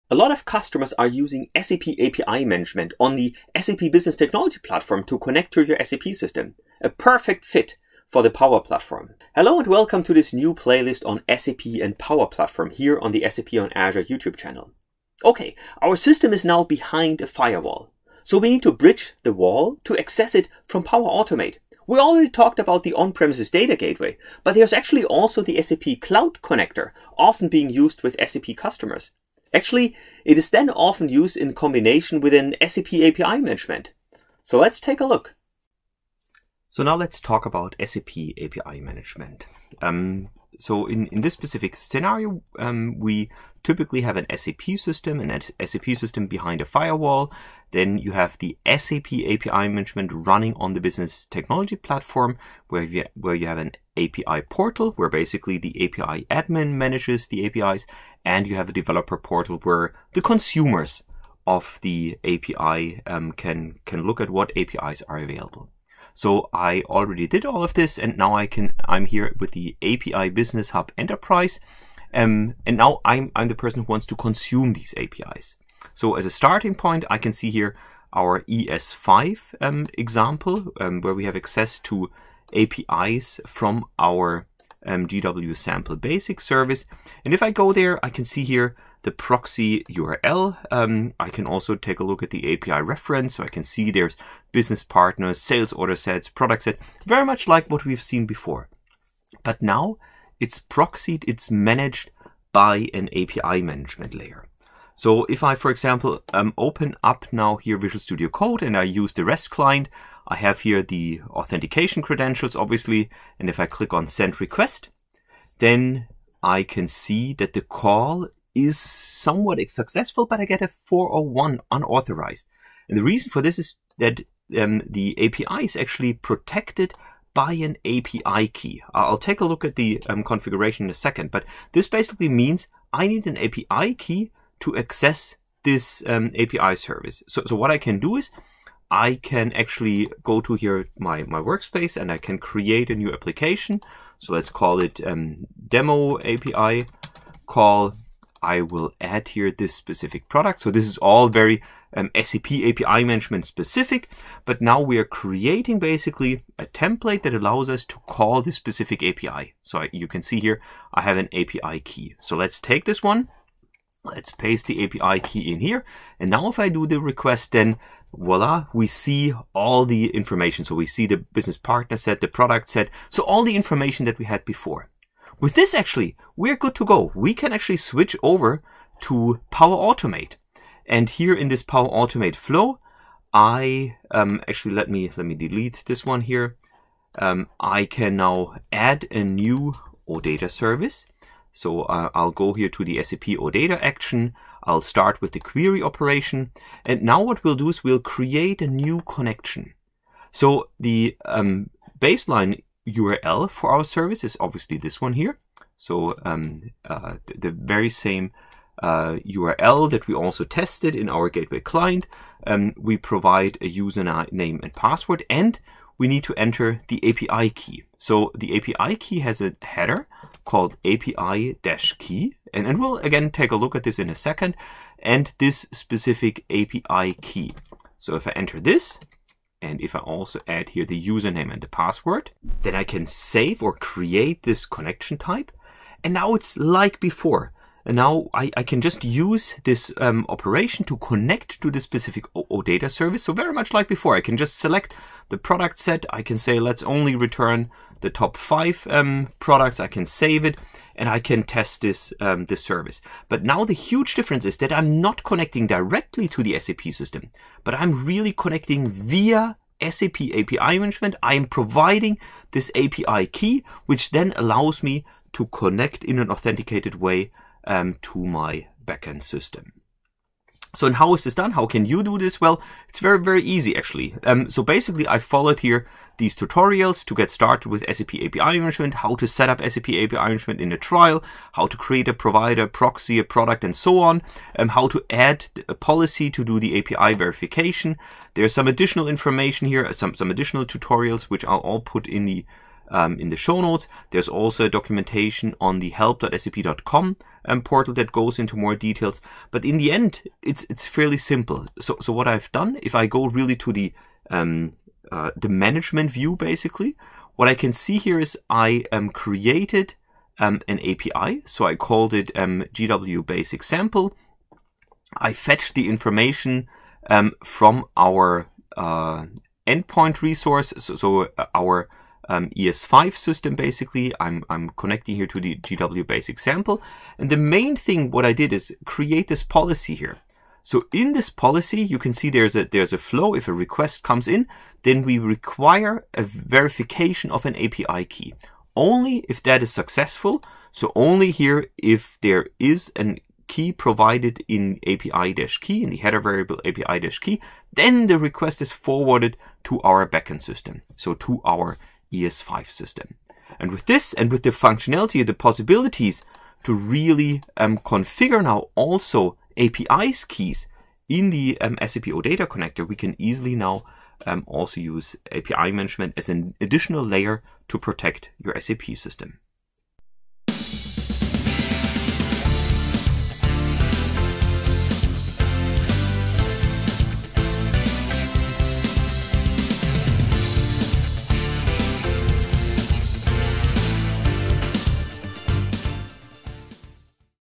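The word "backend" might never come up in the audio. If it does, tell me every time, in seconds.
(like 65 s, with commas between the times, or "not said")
268 s, 350 s.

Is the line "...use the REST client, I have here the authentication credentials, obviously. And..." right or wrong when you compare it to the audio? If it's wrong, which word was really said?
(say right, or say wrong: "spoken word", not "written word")
right.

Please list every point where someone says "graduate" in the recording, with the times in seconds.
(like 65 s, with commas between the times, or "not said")
not said.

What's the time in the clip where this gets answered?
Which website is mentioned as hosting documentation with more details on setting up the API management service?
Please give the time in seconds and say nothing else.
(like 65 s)
295 s.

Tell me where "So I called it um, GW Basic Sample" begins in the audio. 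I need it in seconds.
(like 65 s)
311 s.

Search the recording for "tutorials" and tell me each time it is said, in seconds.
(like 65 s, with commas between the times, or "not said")
276 s, 290 s.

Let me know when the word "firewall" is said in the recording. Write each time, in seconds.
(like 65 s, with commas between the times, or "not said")
17 s, 46 s.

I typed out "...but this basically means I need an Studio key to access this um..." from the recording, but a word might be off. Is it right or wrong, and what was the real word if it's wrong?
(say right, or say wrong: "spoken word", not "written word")
wrong: "API", not "Studio".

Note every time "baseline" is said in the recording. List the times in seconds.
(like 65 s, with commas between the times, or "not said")
201 s.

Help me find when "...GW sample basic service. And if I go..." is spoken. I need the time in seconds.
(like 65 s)
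85 s.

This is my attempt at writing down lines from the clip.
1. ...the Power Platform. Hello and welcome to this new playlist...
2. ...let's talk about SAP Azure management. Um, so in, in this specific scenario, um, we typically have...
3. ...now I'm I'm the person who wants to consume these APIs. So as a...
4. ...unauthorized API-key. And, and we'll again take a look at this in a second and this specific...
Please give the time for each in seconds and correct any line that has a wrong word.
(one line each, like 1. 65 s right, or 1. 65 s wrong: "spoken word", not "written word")
1. 8 s right
2. 36 s wrong: "API", not "Azure"
3. 72 s right
4. 220 s wrong: "called", not "unauthorized".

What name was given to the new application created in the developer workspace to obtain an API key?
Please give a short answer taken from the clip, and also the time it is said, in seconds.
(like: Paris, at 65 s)
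demo API call, at 145 s.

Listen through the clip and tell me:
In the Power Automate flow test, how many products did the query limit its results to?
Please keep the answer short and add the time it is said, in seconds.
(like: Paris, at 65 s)
5, at 248 s.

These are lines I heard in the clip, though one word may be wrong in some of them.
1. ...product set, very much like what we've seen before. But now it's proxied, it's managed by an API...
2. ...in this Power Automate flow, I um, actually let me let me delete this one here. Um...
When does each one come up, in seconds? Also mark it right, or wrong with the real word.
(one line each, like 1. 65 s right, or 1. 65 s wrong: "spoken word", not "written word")
1. 96 s right
2. 181 s right.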